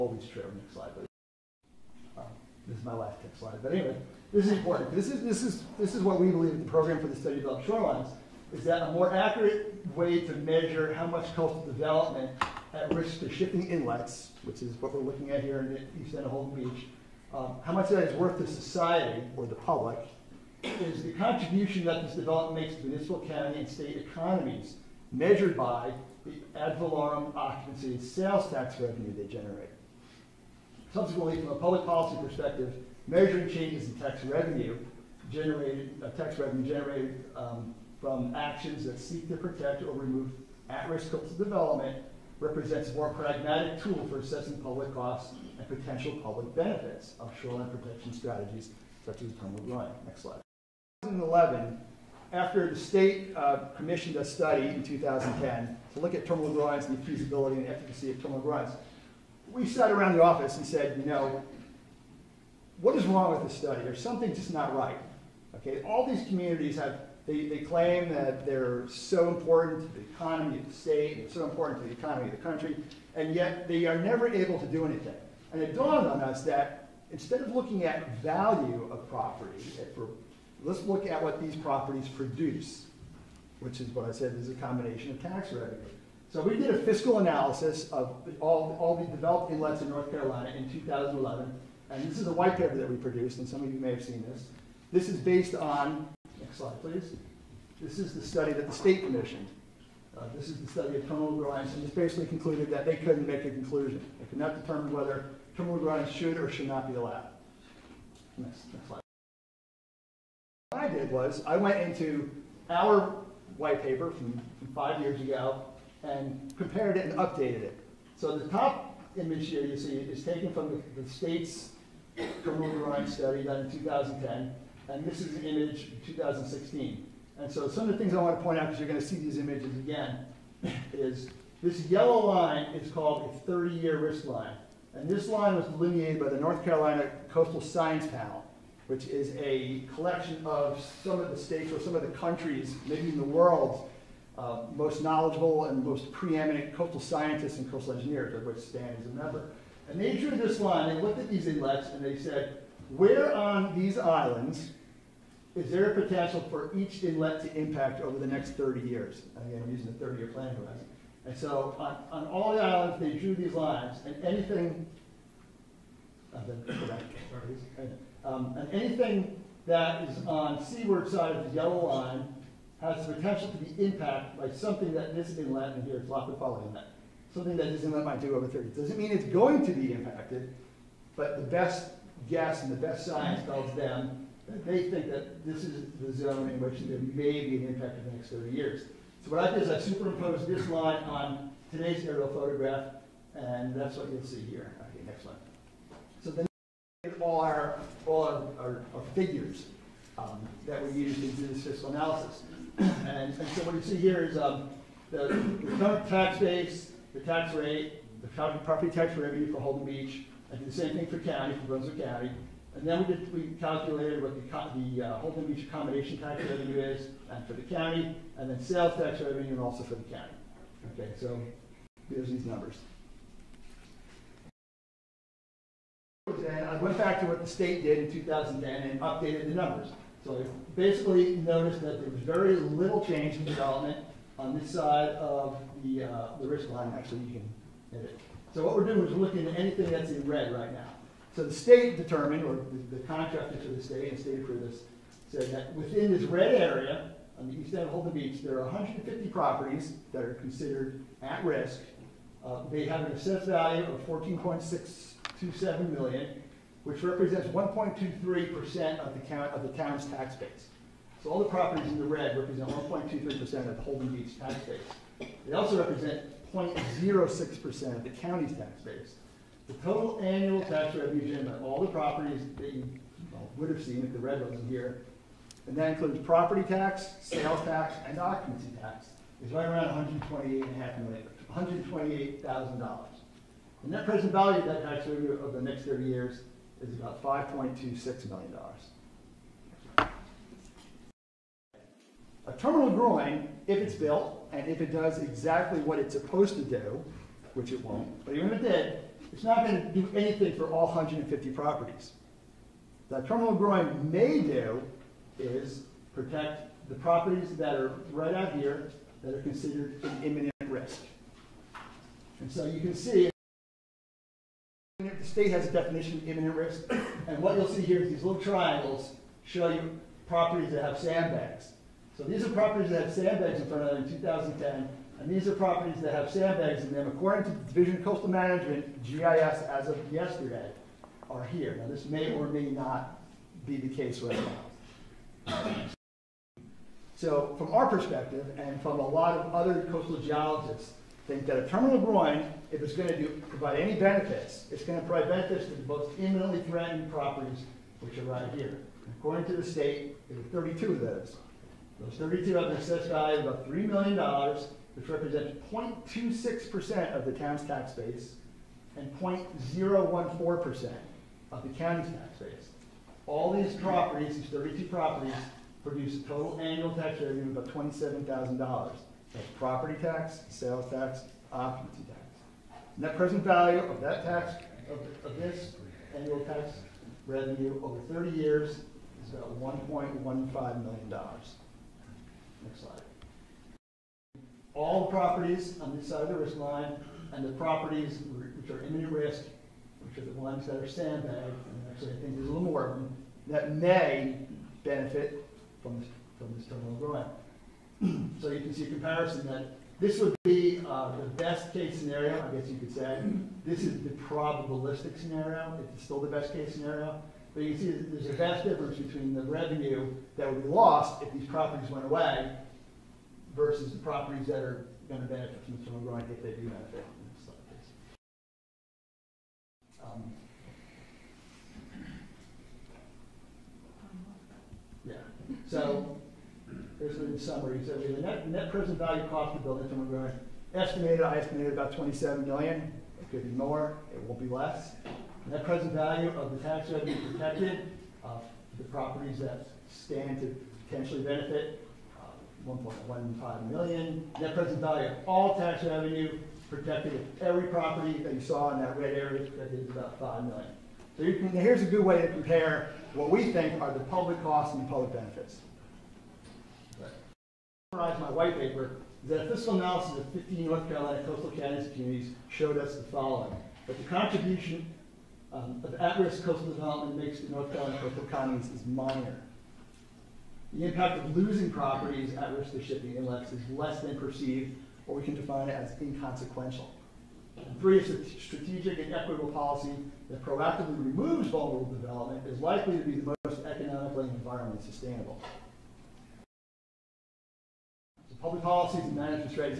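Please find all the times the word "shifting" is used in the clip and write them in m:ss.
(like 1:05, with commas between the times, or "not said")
0:13, 7:52.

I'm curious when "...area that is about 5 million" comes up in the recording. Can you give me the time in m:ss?
7:29.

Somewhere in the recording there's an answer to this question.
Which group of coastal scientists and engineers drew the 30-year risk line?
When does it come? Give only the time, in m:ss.
2:16.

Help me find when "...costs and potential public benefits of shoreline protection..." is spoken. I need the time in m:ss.
0:44.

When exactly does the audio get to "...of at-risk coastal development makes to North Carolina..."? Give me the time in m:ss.
7:45.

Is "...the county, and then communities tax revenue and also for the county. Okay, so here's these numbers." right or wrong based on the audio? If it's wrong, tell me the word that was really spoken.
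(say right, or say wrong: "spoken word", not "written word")
wrong: "sales", not "communities".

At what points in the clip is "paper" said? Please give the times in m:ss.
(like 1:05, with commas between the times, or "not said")
1:32, 1:53, 7:38.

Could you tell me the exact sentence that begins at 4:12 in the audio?
Uh, they have an assessed value of 14.627 million, which represents 1.23% of the count of the town's tax base.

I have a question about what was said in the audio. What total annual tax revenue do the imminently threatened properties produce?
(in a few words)
about $27,000.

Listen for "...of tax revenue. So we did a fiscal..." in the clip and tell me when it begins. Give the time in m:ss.
1:25.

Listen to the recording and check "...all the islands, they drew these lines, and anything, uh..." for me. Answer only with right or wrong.
right.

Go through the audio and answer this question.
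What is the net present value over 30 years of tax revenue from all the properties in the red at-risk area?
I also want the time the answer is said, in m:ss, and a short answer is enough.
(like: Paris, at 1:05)
$5.26 million, at 4:47.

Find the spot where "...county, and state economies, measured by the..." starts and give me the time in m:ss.
0:23.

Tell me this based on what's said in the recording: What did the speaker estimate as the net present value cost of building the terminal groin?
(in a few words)
27 million.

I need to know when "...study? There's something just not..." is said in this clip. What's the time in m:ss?
1:03.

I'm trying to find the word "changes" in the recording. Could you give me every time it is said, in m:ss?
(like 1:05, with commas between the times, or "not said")
0:33, 3:53.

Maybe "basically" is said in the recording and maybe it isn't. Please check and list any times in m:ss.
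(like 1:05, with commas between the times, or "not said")
1:41, 3:50.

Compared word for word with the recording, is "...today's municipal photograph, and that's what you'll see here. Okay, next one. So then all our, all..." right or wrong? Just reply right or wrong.
wrong.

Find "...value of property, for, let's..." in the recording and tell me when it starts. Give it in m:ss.
1:18.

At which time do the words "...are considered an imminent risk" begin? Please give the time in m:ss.
5:09.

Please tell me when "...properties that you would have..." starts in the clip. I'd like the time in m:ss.
4:31.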